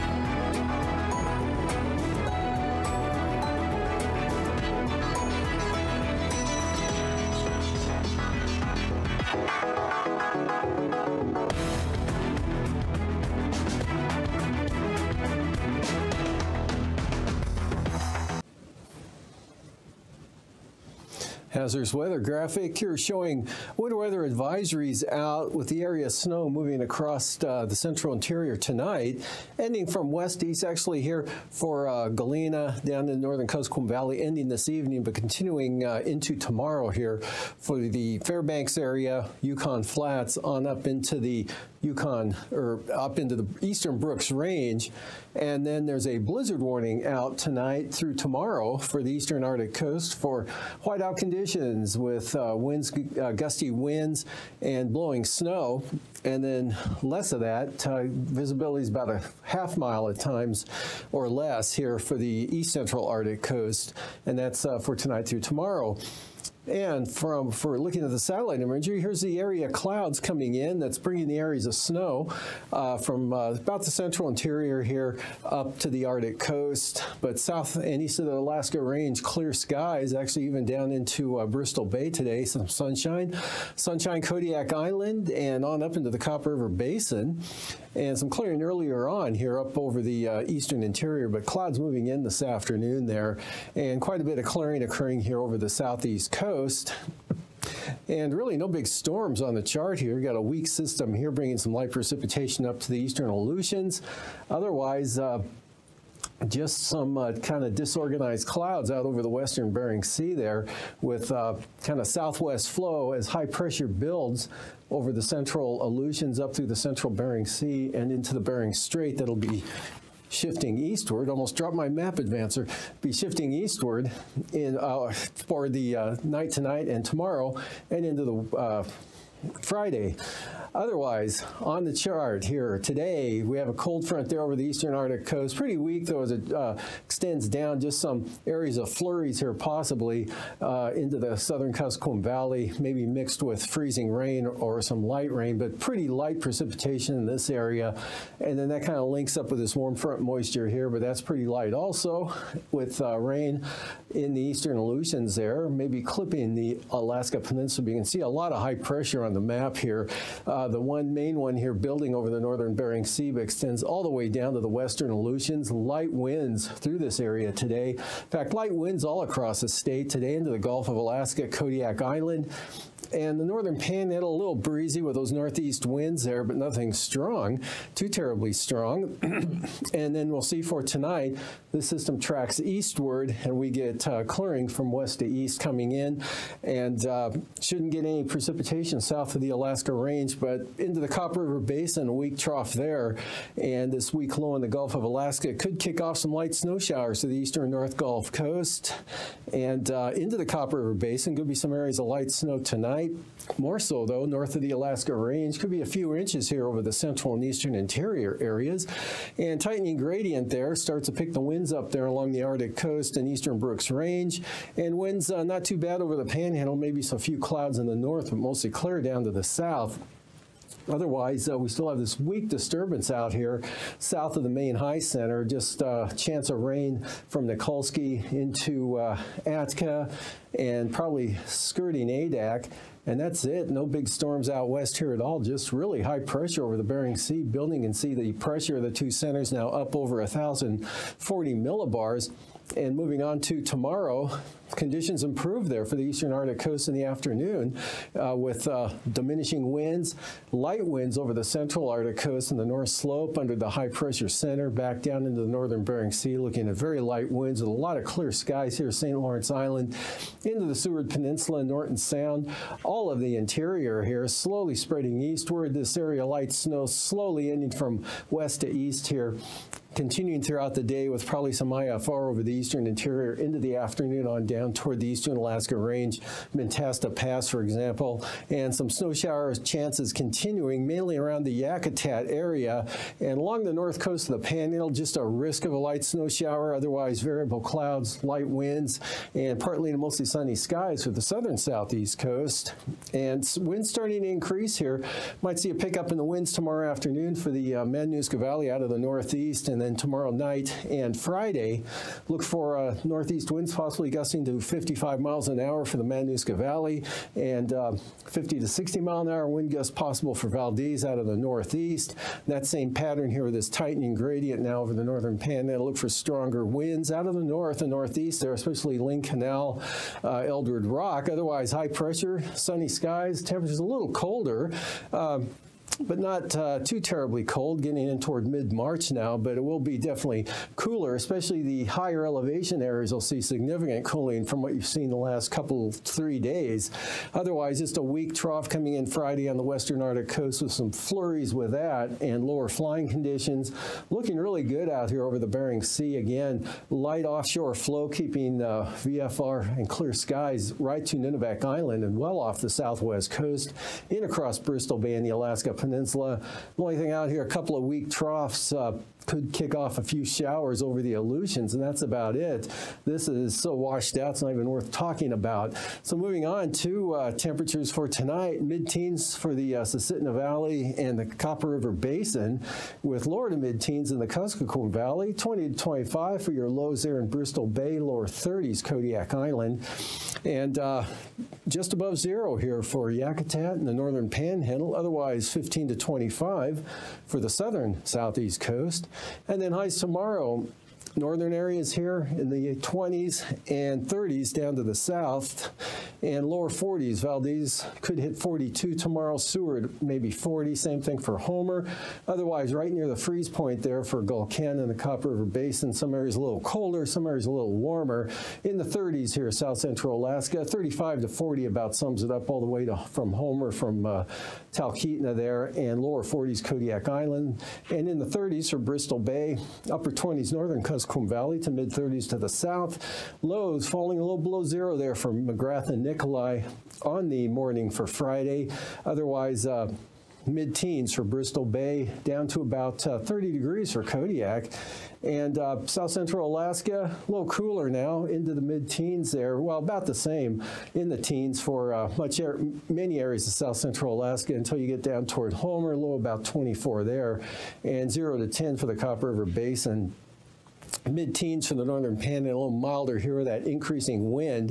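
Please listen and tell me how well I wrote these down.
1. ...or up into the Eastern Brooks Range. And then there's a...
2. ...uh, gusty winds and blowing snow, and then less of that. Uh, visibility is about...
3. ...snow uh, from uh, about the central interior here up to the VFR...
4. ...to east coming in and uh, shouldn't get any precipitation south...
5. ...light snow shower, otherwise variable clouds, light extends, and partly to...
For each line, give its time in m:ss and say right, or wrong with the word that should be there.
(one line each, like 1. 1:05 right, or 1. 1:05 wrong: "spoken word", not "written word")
1. 0:42 right
2. 0:53 right
3. 1:11 wrong: "Arctic", not "VFR"
4. 3:05 right
5. 4:45 wrong: "winds", not "extends".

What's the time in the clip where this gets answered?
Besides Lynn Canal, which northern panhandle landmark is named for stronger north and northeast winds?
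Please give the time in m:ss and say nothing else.
5:20.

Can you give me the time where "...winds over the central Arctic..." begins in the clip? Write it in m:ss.
4:10.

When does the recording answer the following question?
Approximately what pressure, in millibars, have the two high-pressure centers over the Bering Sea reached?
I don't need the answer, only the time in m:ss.
4:00.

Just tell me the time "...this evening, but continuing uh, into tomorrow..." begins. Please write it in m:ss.
0:34.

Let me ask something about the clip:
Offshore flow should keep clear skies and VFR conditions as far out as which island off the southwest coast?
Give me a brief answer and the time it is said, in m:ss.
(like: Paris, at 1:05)
Nunivak Island, at 5:51.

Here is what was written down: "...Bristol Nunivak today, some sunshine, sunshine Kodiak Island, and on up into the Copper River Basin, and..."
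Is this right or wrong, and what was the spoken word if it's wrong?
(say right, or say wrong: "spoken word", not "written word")
wrong: "Bay", not "Nunivak".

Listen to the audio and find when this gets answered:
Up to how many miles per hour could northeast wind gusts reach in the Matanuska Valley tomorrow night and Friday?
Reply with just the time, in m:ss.
5:04.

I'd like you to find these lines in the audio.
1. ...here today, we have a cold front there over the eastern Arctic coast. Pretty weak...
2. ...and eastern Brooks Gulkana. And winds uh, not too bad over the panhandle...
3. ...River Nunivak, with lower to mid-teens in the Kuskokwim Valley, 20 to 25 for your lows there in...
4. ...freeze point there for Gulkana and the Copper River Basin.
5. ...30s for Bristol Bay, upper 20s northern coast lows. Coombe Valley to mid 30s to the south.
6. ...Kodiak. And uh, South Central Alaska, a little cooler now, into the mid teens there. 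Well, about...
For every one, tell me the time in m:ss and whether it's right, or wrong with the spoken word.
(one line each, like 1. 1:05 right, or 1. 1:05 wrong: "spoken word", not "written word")
1. 2:12 right
2. 3:33 wrong: "Range", not "Gulkana"
3. 6:11 wrong: "Basin", not "Nunivak"
4. 6:43 right
5. 6:58 right
6. 7:14 right.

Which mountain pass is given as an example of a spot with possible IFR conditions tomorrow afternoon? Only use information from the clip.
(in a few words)
Mentasta Pass.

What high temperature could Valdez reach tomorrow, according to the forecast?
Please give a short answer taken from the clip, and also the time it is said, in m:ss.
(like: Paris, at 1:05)
42, at 6:38.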